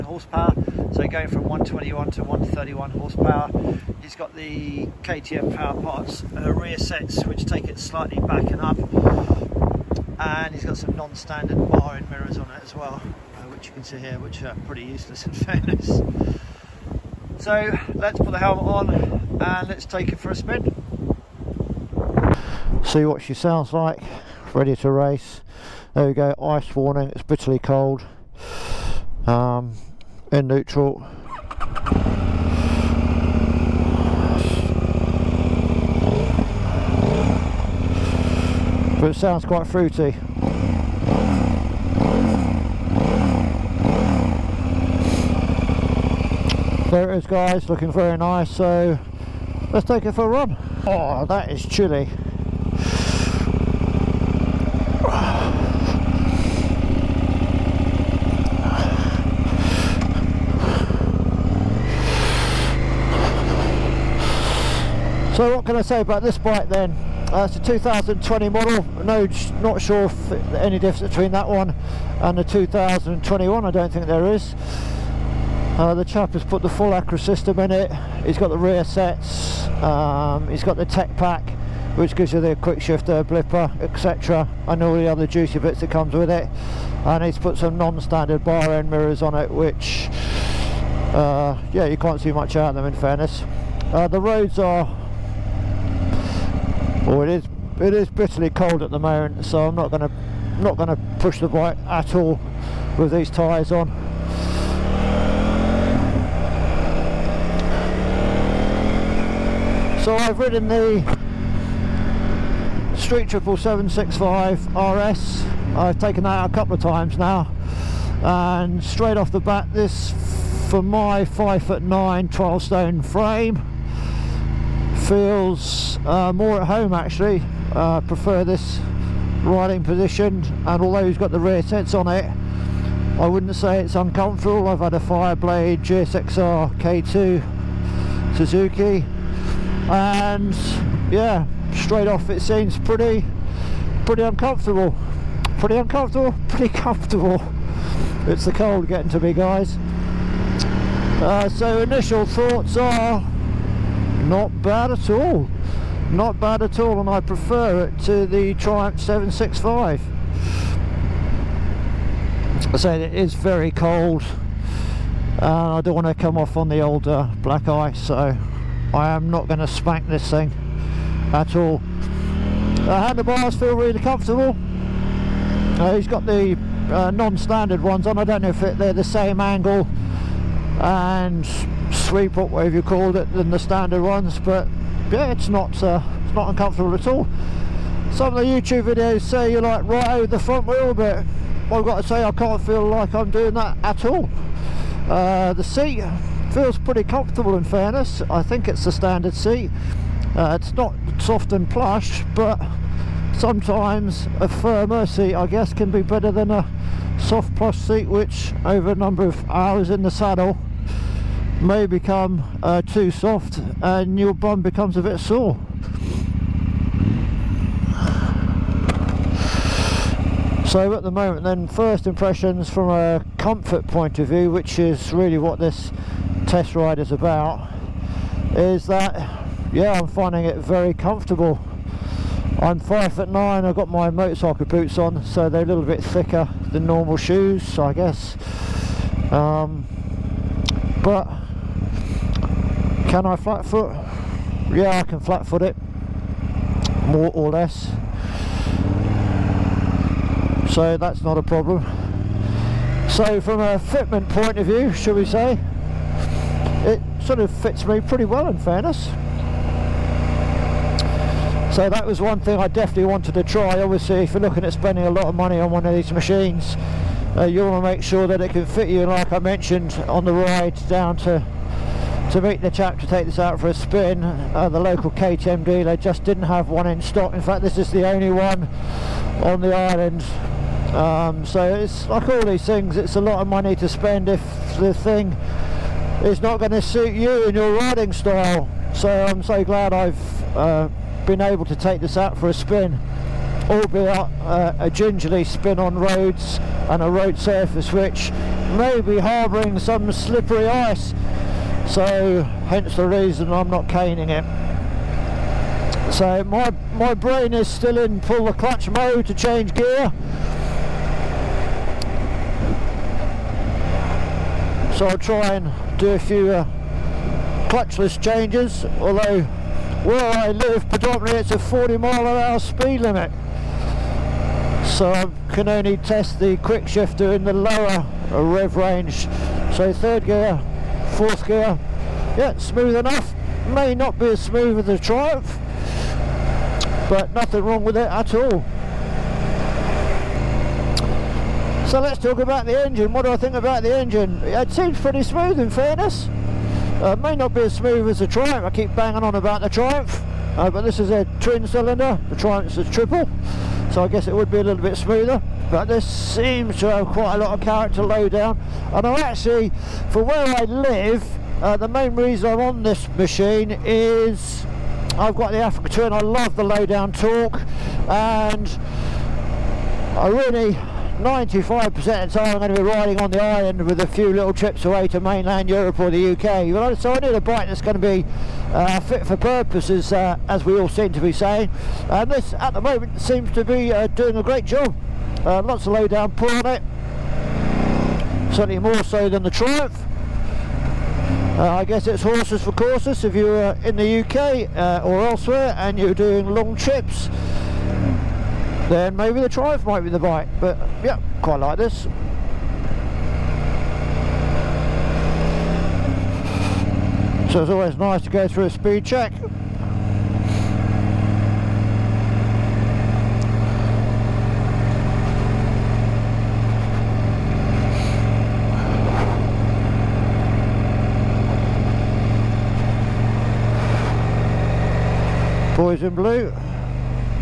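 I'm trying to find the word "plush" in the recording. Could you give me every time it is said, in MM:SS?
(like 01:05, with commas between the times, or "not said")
03:21, 03:27.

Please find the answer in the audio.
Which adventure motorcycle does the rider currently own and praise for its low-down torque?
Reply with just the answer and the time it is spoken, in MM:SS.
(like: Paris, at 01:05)
Africa Twin, at 06:05.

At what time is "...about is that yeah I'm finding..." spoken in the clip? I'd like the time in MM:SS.
03:47.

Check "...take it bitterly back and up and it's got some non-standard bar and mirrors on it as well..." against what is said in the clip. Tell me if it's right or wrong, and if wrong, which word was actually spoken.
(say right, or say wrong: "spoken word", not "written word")
wrong: "slightly", not "bitterly".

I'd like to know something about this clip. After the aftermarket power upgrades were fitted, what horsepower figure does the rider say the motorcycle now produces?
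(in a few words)
131.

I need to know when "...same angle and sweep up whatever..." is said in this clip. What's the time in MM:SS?
02:59.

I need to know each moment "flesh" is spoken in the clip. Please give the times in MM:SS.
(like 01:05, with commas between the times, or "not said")
not said.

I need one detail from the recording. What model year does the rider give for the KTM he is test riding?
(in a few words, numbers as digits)
2020.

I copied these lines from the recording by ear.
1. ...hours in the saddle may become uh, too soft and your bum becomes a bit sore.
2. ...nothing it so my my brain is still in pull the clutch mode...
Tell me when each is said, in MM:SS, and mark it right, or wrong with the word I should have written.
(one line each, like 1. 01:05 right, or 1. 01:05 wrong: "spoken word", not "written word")
1. 03:29 right
2. 05:03 wrong: "caning", not "nothing".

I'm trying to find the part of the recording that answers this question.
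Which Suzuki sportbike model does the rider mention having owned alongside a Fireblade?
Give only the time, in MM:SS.
02:15.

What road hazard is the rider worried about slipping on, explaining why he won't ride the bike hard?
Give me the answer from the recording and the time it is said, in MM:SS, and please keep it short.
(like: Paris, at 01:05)
black ice, at 02:47.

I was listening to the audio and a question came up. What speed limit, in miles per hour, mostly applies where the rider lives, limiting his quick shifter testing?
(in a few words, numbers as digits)
40.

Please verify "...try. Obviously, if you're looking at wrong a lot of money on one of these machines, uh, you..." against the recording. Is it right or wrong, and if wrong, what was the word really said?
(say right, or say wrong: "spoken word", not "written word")
wrong: "spending", not "wrong".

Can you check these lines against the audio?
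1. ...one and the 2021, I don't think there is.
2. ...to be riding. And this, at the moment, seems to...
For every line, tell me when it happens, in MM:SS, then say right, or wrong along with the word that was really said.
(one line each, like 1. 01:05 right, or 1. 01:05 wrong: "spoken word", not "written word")
1. 01:11 right
2. 06:21 wrong: "saying", not "riding".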